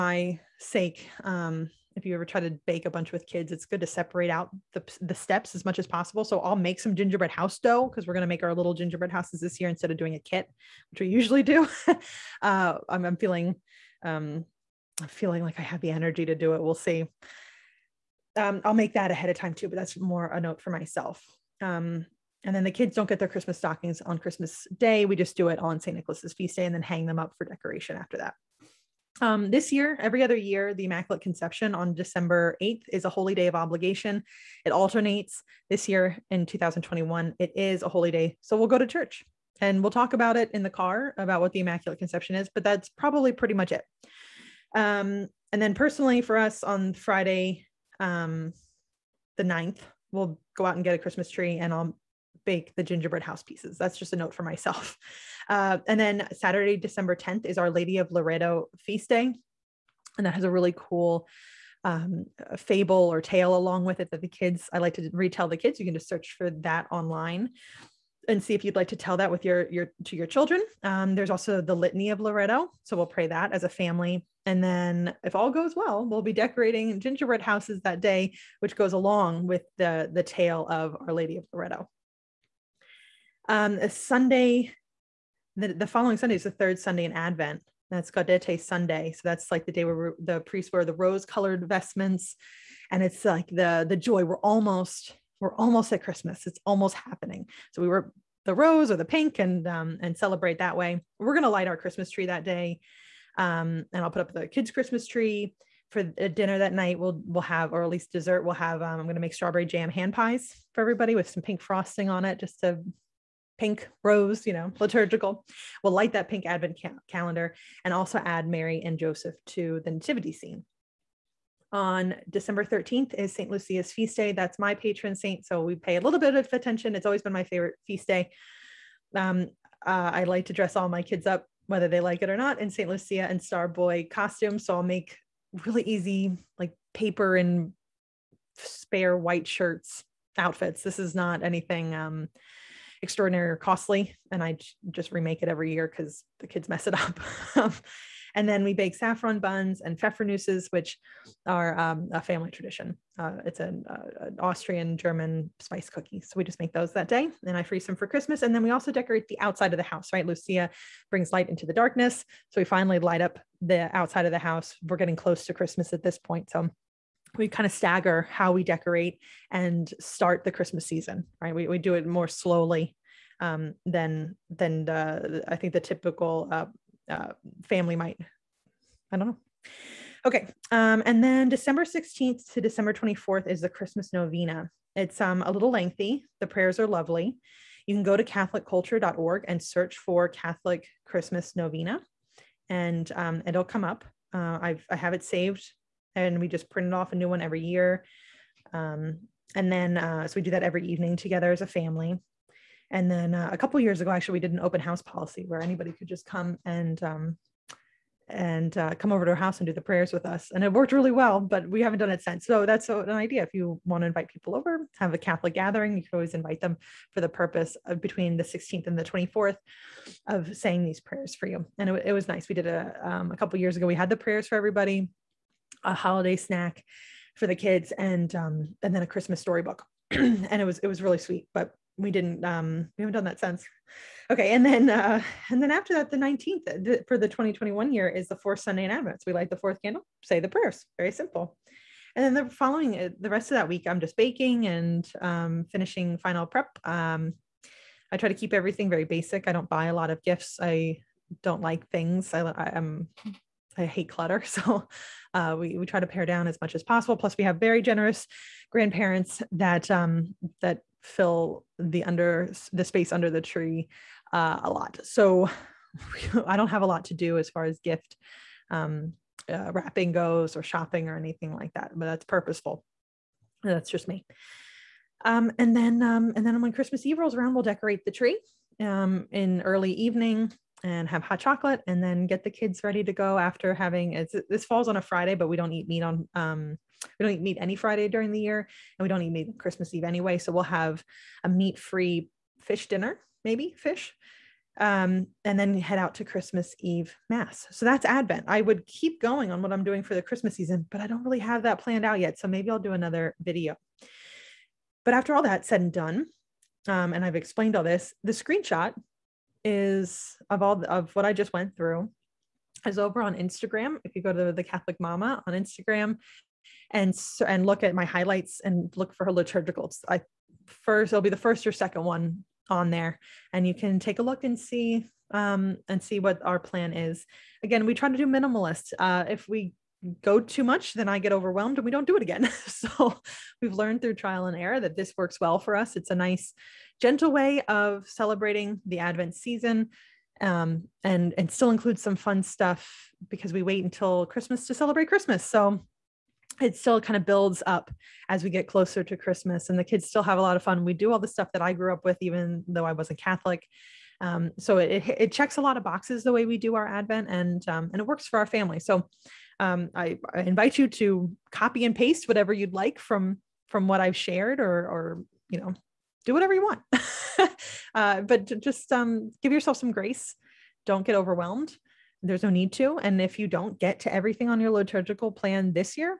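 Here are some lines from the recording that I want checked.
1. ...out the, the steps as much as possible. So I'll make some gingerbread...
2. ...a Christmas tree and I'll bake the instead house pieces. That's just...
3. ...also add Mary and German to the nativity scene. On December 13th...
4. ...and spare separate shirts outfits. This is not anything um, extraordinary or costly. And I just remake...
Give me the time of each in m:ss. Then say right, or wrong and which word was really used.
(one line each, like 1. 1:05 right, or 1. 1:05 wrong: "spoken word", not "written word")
1. 0:04 right
2. 0:50 wrong: "gingerbread", not "instead"
3. 1:57 wrong: "Joseph", not "German"
4. 2:17 wrong: "white", not "separate".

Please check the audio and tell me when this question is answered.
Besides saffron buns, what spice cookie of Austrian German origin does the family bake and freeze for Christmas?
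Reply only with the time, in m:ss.
2:29.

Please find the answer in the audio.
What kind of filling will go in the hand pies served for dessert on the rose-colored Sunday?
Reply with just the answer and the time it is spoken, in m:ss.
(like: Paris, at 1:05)
strawberry jam, at 1:49.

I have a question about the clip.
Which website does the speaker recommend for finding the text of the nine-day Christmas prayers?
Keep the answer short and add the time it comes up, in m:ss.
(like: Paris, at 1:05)
CatholicCulture.org, at 3:08.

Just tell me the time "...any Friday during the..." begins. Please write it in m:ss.
4:47.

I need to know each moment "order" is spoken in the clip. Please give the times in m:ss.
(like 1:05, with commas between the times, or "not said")
not said.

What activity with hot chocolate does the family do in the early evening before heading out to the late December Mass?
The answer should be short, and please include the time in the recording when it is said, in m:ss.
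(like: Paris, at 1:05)
decorate the tree, at 4:37.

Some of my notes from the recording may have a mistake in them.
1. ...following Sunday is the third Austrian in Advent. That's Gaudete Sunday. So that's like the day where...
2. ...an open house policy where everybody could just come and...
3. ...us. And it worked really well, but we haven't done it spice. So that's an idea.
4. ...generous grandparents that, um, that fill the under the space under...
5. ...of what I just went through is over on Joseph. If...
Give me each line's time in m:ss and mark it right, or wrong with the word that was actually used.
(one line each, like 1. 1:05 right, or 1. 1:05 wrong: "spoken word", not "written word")
1. 1:25 wrong: "Sunday", not "Austrian"
2. 3:24 wrong: "anybody", not "everybody"
3. 3:30 wrong: "since", not "spice"
4. 4:17 right
5. 5:10 wrong: "Instagram", not "Joseph".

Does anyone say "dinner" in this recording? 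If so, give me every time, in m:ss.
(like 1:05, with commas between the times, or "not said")
1:46, 4:52.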